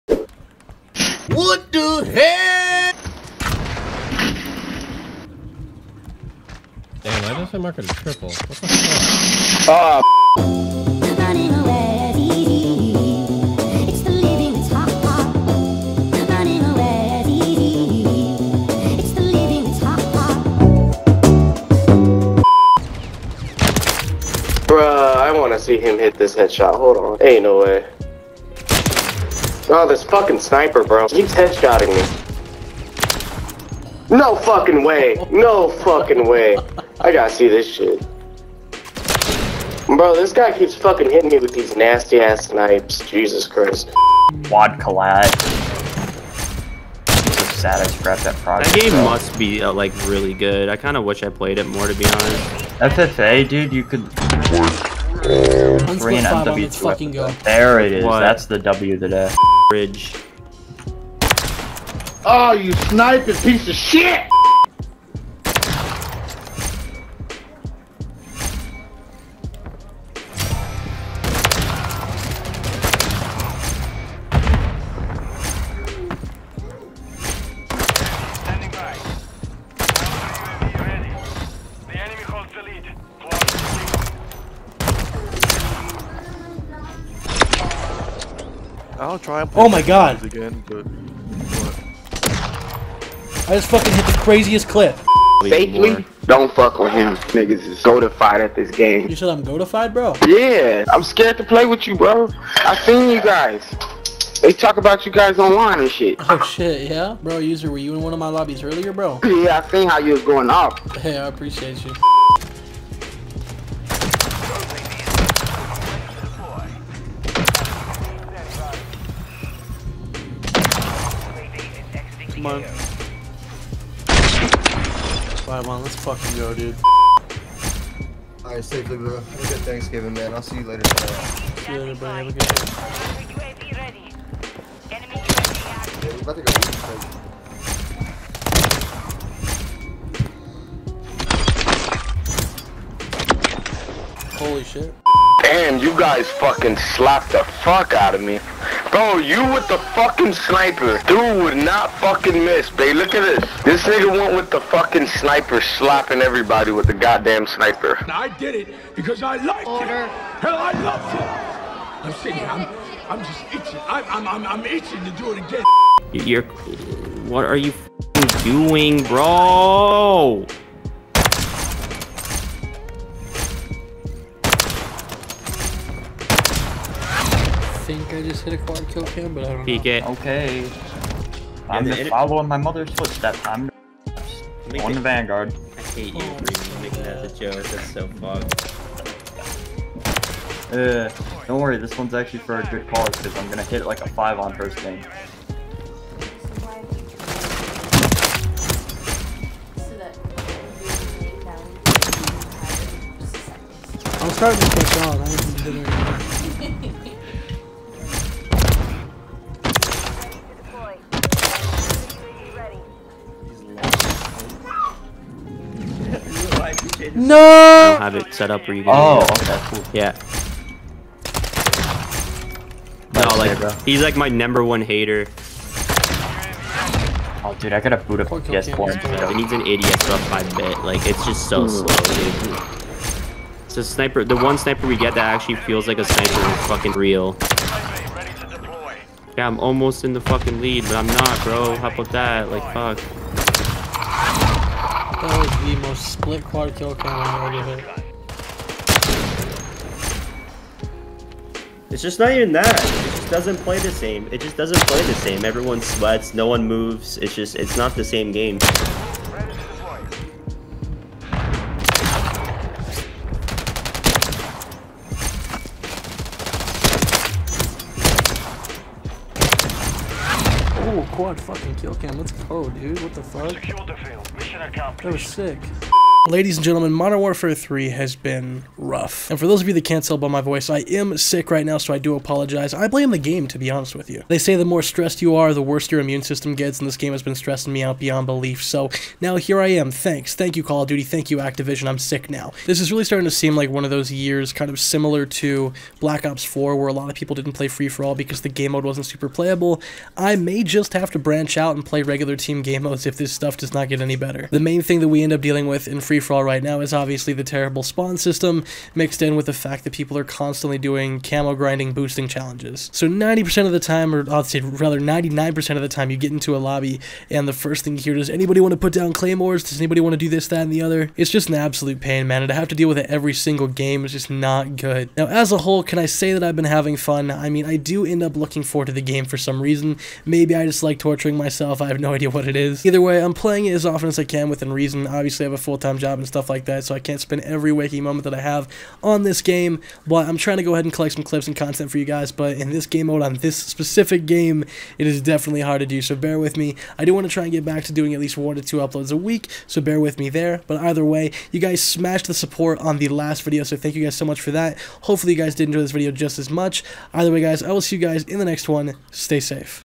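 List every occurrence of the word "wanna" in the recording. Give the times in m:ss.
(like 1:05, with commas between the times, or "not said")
0:25.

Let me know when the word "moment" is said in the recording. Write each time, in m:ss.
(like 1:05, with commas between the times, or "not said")
5:38.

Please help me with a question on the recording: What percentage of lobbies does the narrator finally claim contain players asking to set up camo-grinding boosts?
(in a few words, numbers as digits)
99%.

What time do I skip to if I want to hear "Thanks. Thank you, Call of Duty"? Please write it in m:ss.
4:49.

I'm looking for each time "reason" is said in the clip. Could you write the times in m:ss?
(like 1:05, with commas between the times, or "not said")
5:29, 5:34.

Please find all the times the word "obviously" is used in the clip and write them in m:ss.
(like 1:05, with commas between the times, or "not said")
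5:06, 5:35.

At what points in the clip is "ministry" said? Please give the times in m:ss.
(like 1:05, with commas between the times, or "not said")
not said.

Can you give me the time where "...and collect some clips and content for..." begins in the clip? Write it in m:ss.
5:40.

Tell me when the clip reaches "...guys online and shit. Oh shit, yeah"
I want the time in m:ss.
1:45.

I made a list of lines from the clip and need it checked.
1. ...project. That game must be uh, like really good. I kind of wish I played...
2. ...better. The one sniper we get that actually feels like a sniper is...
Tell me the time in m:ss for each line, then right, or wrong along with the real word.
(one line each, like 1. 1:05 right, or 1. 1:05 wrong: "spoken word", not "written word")
1. 0:48 right
2. 3:53 wrong: "sniper", not "better".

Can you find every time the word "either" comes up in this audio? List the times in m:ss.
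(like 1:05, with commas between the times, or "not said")
5:32, 5:50, 5:57.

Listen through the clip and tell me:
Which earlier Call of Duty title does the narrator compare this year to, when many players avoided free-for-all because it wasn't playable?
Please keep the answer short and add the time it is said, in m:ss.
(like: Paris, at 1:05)
Black Ops 4, at 4:55.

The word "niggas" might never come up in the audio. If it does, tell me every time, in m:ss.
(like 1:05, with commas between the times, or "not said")
1:37, 2:33.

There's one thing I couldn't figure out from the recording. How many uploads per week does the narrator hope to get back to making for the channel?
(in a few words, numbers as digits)
1 to 2.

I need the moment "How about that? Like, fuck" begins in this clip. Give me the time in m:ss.
4:01.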